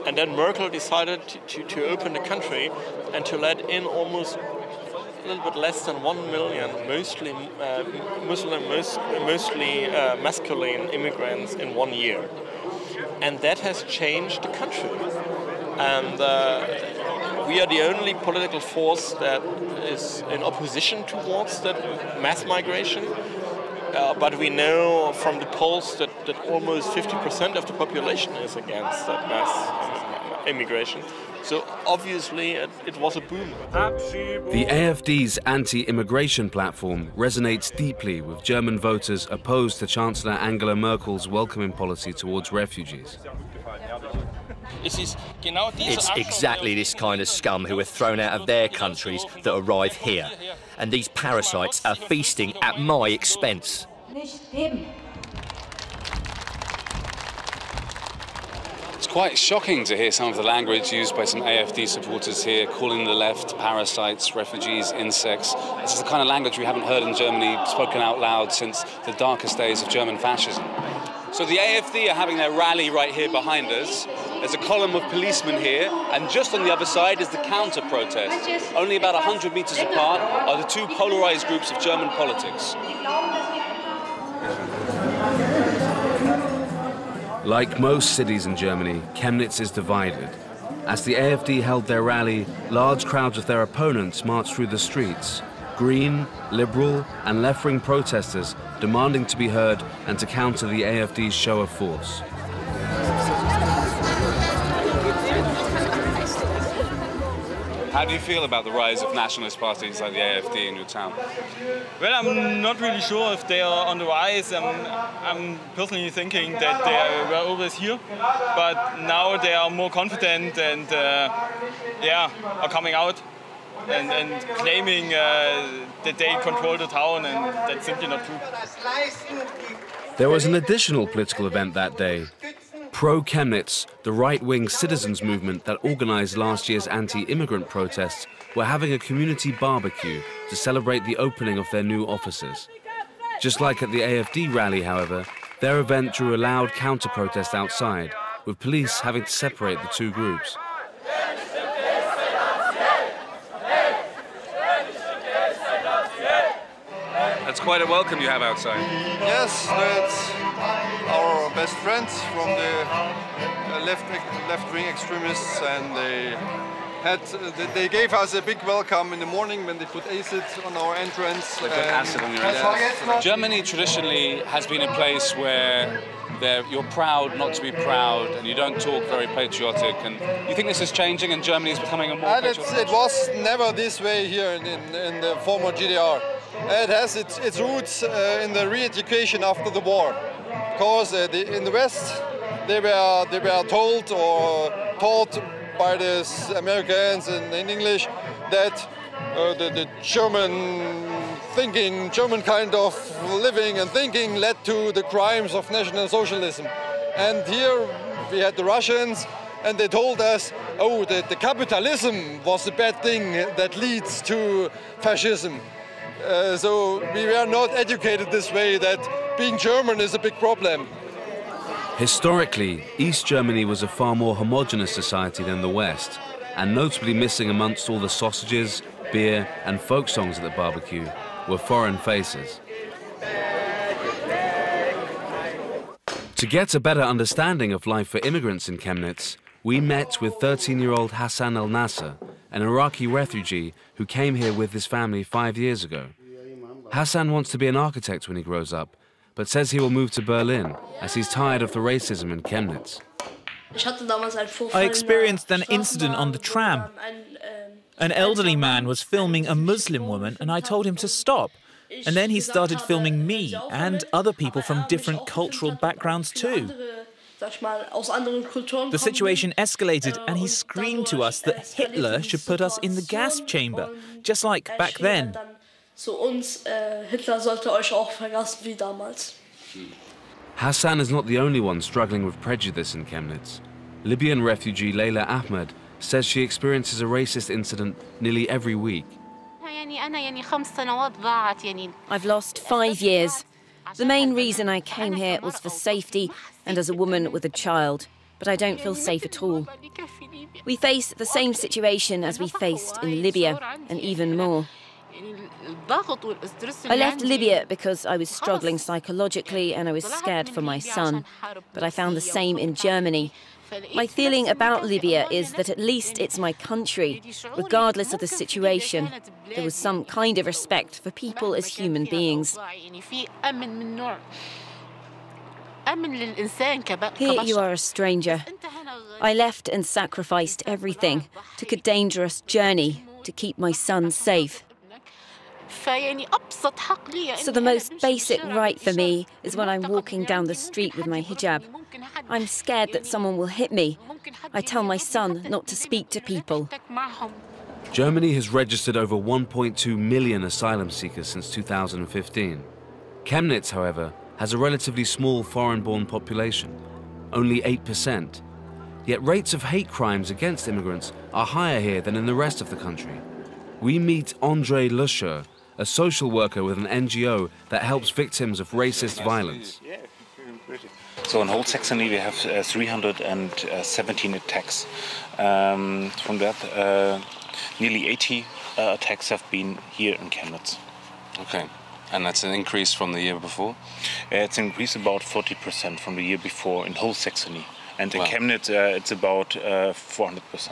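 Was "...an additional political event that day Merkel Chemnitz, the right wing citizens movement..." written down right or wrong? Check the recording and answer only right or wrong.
wrong.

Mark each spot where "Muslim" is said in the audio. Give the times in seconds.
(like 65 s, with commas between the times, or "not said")
8 s, 259 s.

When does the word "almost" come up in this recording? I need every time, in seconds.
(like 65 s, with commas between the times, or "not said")
3 s, 26 s.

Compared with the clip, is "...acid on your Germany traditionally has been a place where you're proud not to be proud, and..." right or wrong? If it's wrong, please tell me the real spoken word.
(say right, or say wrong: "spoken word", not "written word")
right.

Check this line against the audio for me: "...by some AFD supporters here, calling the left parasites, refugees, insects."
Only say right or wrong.
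right.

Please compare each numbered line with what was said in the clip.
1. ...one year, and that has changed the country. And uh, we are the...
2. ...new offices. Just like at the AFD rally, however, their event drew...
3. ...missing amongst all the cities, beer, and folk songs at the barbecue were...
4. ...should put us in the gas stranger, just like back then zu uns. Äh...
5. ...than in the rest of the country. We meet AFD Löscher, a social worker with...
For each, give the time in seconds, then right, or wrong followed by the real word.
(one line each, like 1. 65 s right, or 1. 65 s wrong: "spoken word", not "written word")
1. 11 s right
2. 141 s right
3. 227 s wrong: "sausages", not "cities"
4. 272 s wrong: "chamber", not "stranger"
5. 362 s wrong: "Andre", not "AFD".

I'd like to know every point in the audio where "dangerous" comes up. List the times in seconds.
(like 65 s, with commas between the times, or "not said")
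331 s.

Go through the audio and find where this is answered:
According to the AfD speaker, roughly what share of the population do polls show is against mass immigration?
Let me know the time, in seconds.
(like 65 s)
26 s.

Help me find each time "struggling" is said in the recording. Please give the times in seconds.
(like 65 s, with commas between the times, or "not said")
281 s, 308 s.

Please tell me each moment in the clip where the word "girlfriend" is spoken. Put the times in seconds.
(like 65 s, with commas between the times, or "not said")
not said.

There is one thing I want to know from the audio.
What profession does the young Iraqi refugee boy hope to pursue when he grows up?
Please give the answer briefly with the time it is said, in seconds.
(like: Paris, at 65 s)
architect, at 247 s.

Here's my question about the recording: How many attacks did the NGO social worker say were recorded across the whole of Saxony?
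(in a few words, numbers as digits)
317.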